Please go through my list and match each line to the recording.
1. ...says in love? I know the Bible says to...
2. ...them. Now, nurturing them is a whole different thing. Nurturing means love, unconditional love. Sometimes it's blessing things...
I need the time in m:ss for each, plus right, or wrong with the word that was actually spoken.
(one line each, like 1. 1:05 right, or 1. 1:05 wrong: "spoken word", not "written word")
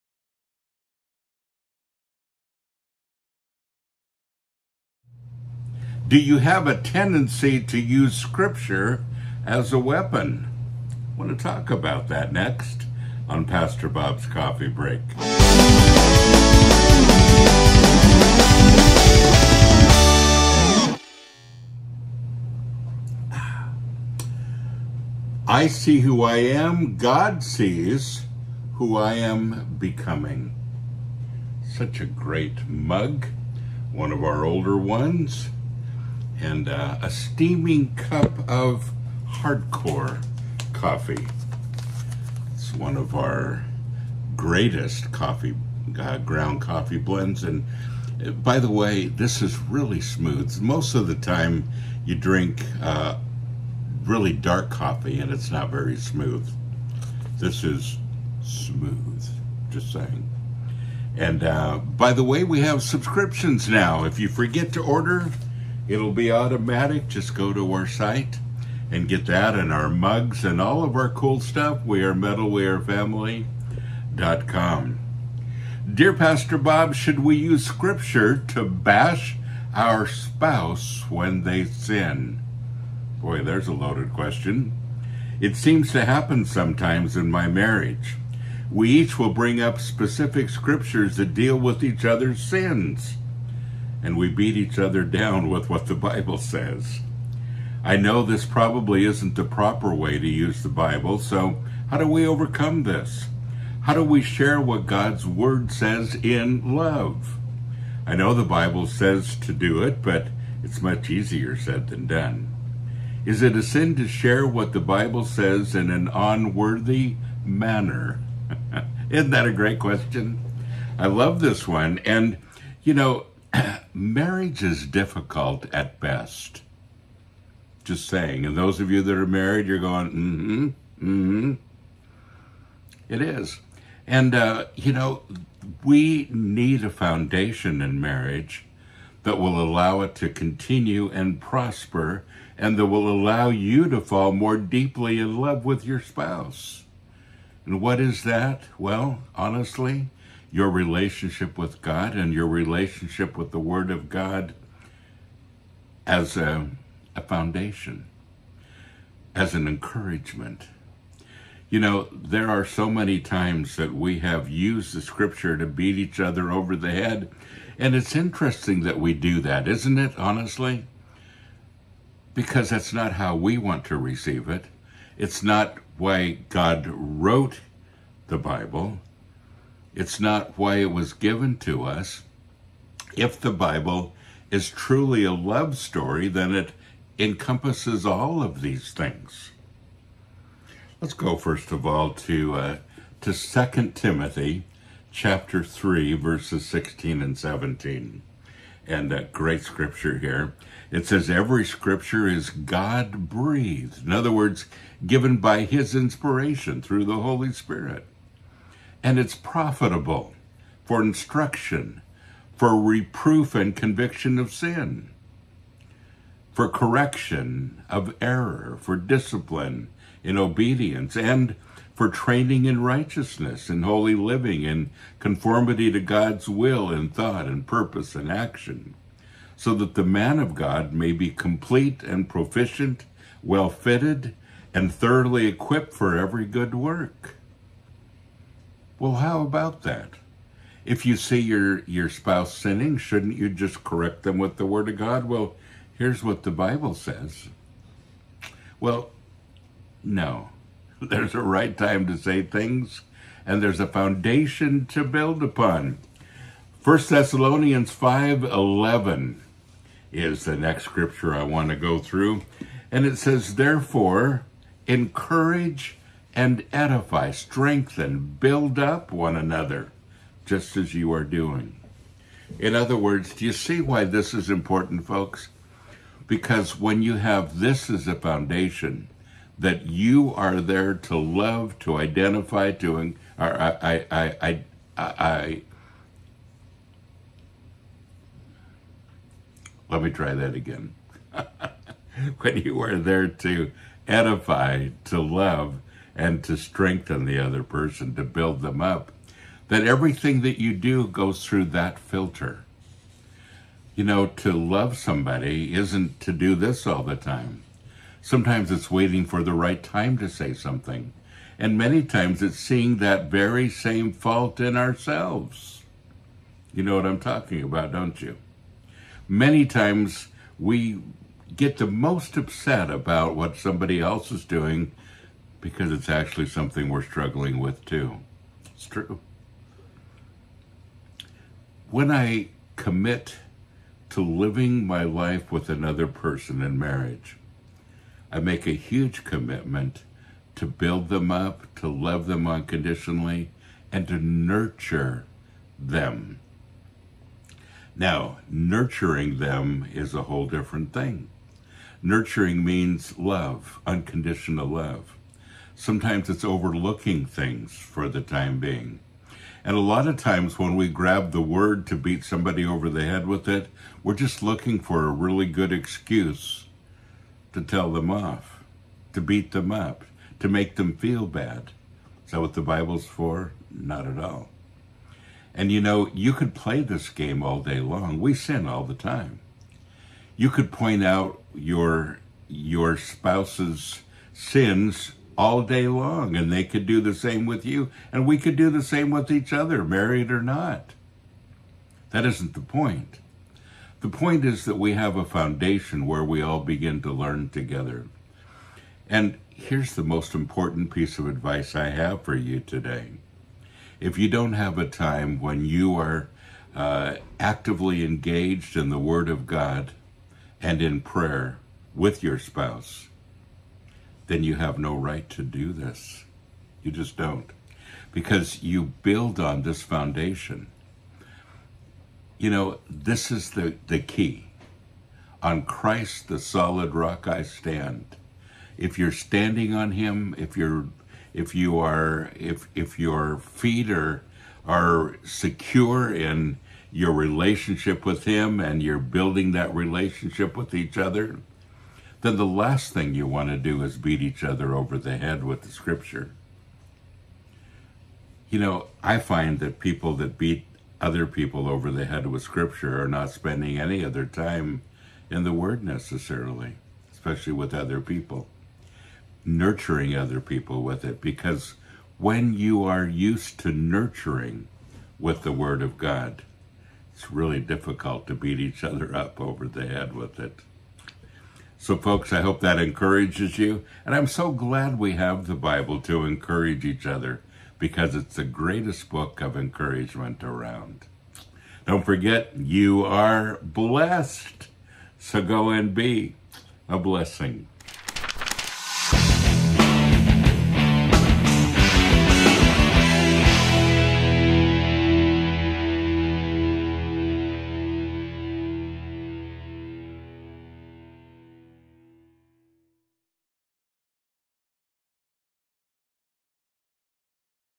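1. 1:45 right
2. 5:45 wrong: "overlooking", not "blessing".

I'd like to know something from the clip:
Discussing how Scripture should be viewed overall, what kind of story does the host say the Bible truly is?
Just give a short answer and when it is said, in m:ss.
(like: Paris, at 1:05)
a love story, at 3:05.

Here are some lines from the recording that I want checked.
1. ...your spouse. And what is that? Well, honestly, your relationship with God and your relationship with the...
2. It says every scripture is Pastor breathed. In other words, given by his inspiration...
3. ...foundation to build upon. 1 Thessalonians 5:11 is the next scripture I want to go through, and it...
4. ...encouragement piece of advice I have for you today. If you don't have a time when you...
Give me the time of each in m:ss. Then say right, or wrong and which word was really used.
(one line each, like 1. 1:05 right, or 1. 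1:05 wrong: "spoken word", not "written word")
1. 2:25 right
2. 3:20 wrong: "God", not "Pastor"
3. 4:13 right
4. 6:40 wrong: "important", not "encouragement".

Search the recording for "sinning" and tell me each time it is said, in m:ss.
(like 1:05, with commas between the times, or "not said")
4:02.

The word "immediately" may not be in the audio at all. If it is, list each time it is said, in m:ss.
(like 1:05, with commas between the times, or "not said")
not said.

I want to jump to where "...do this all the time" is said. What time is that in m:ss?
5:06.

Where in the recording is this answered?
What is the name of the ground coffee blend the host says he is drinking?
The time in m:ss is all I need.
0:39.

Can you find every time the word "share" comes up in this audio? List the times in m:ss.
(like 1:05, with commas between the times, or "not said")
1:44, 1:54.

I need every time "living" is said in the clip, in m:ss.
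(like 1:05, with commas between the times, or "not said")
3:44, 5:34.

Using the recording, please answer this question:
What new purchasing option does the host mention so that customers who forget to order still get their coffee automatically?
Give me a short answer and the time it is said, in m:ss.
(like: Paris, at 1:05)
subscriptions, at 1:02.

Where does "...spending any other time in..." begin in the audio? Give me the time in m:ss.
7:33.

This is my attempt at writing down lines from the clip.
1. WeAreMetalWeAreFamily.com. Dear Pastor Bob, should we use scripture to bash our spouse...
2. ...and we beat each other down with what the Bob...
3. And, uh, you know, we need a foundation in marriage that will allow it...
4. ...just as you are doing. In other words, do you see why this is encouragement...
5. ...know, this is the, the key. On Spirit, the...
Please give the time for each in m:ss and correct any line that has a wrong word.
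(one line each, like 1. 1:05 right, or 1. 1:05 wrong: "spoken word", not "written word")
1. 1:11 right
2. 1:34 wrong: "Bible", not "Bob"
3. 2:14 right
4. 4:30 wrong: "important", not "encouragement"
5. 7:02 wrong: "Christ", not "Spirit".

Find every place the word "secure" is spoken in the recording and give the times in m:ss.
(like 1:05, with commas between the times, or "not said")
7:15.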